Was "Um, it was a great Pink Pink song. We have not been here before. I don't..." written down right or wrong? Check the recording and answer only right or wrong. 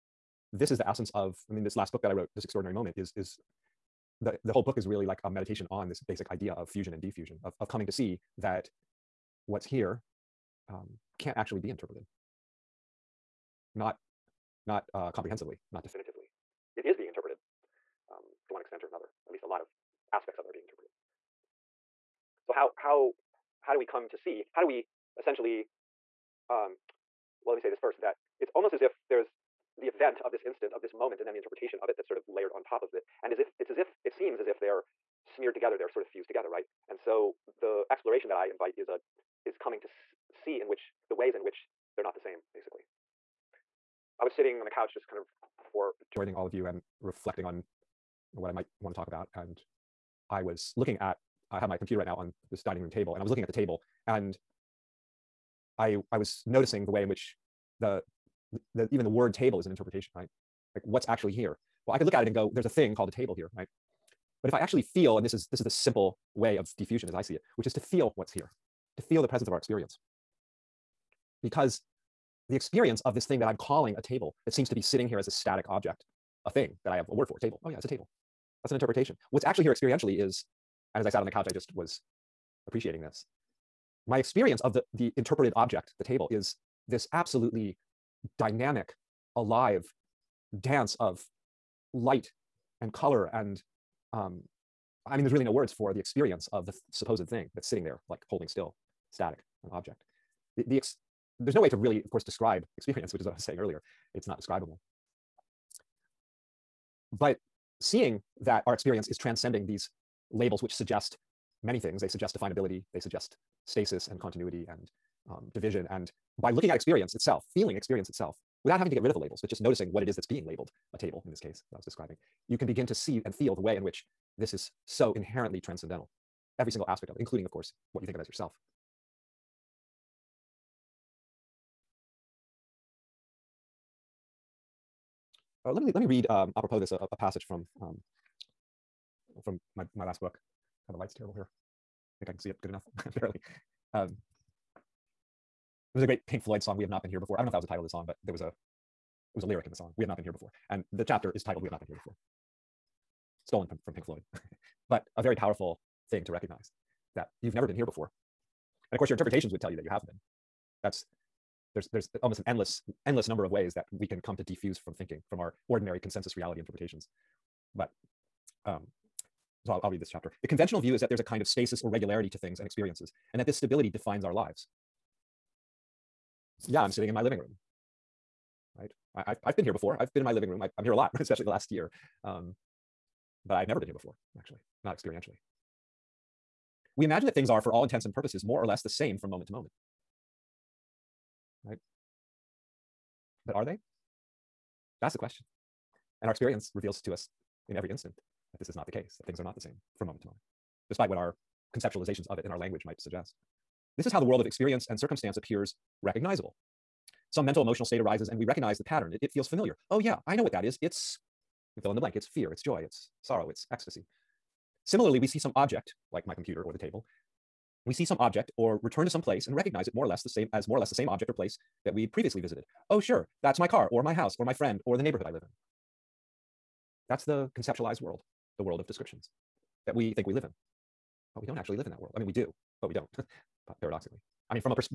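wrong.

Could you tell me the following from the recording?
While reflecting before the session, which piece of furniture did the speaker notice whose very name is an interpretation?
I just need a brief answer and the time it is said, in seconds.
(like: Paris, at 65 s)
Dining room table, at 52 s.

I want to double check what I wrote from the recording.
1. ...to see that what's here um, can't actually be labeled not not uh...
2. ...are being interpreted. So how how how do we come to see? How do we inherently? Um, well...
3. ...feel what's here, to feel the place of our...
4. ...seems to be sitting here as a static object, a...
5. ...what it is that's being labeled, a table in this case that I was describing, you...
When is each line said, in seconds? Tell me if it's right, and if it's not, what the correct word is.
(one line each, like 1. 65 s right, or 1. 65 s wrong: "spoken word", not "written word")
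1. 7 s wrong: "interpreted", not "labeled"
2. 20 s wrong: "essentially", not "inherently"
3. 67 s wrong: "presence", not "place"
4. 74 s right
5. 119 s right.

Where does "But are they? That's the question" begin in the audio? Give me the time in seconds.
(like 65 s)
193 s.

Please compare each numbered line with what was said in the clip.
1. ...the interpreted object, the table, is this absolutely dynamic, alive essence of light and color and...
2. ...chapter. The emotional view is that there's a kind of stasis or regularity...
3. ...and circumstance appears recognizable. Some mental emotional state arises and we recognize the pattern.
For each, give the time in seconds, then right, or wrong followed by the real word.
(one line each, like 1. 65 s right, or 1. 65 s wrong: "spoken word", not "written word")
1. 84 s wrong: "dance", not "essence"
2. 170 s wrong: "conventional", not "emotional"
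3. 204 s right.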